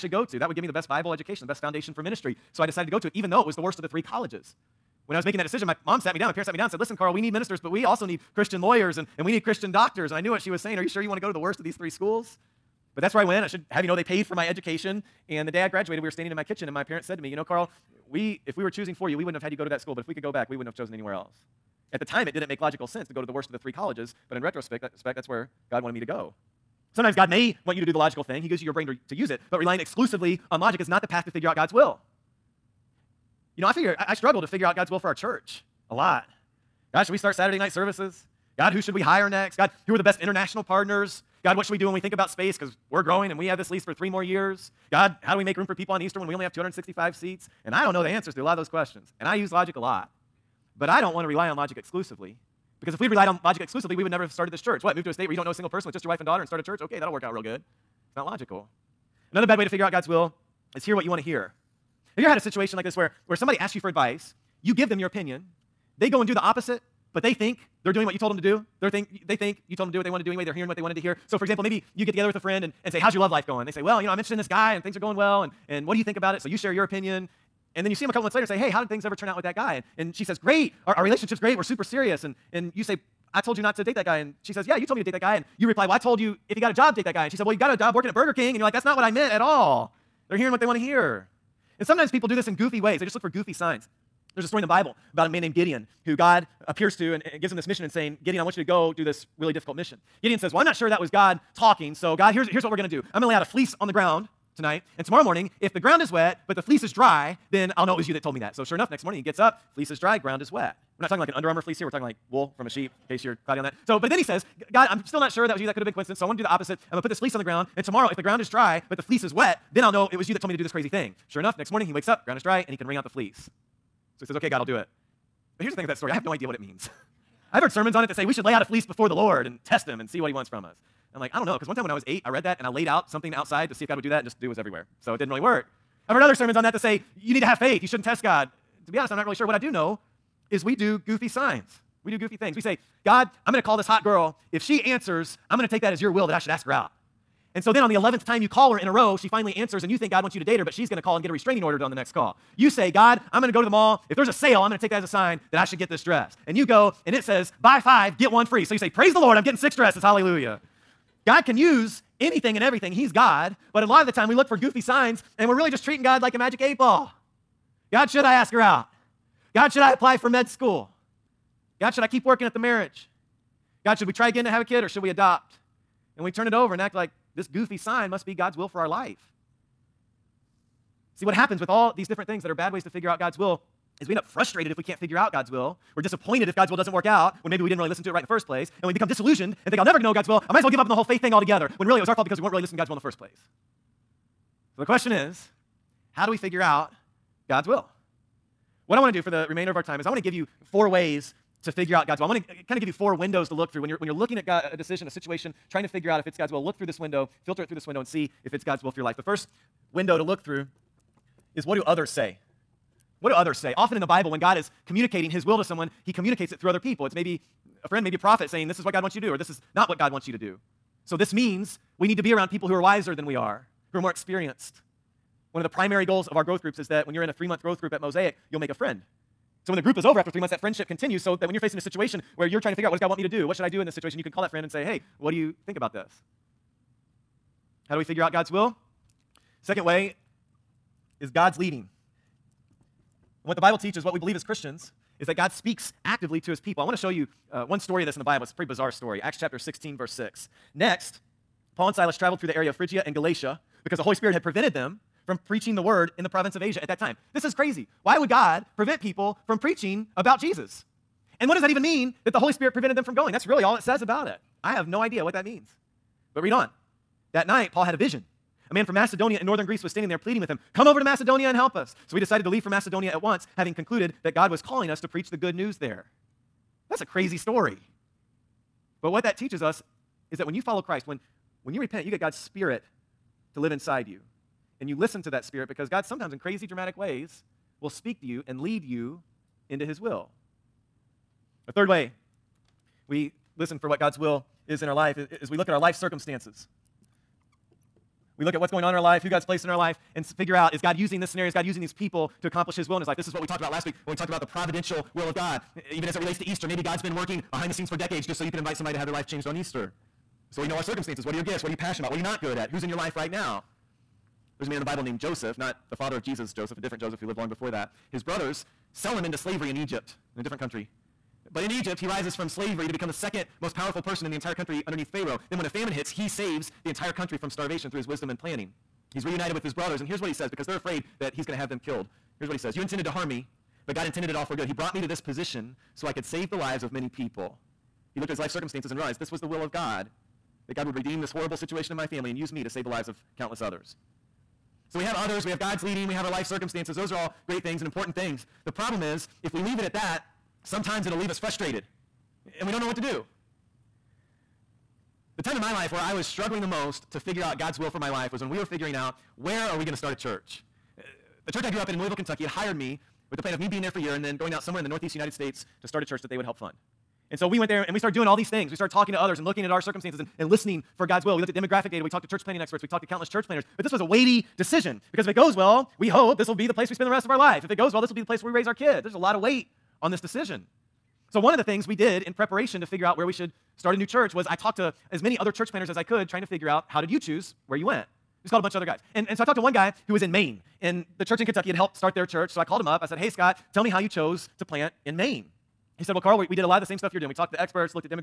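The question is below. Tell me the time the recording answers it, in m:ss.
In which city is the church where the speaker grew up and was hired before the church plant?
6:01.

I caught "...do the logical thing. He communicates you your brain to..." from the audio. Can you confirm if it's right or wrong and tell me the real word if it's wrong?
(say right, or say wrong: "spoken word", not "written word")
wrong: "gives", not "communicates".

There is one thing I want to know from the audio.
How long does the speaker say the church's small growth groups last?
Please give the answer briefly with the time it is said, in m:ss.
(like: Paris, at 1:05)
3 months, at 3:47.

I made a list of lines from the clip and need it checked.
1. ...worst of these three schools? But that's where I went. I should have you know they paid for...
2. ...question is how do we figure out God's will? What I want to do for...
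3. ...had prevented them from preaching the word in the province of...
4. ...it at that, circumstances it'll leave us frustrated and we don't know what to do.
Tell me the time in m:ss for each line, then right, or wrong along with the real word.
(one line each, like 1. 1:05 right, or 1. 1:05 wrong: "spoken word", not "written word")
1. 0:11 right
2. 3:14 right
3. 4:14 right
4. 5:49 wrong: "sometimes", not "circumstances".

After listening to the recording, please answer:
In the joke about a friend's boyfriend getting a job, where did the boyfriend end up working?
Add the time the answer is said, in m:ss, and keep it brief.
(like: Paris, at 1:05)
Burger King, at 1:28.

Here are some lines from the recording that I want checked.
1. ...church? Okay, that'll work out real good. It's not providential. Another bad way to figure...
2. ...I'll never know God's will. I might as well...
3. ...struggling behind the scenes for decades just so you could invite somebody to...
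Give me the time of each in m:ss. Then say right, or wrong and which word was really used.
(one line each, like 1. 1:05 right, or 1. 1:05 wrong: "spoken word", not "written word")
1. 0:56 wrong: "logical", not "providential"
2. 3:09 right
3. 5:07 wrong: "working", not "struggling".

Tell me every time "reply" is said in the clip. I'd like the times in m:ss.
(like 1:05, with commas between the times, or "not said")
1:25.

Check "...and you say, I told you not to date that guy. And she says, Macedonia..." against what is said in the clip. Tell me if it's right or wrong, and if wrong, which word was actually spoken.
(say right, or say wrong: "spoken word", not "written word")
wrong: "Yeah", not "Macedonia".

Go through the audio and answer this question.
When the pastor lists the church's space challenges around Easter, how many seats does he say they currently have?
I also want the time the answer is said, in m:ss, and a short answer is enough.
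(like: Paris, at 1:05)
265, at 0:46.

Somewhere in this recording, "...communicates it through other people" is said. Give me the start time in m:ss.
3:36.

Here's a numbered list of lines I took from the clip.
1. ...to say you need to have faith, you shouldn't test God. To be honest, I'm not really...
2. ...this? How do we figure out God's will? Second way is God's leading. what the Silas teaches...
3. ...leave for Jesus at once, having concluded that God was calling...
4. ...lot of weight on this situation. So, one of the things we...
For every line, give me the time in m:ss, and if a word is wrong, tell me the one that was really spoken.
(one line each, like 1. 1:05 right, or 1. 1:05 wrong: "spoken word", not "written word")
1. 2:16 right
2. 3:55 wrong: "Bible", not "Silas"
3. 4:32 wrong: "Macedonia", not "Jesus"
4. 6:19 wrong: "decision", not "situation".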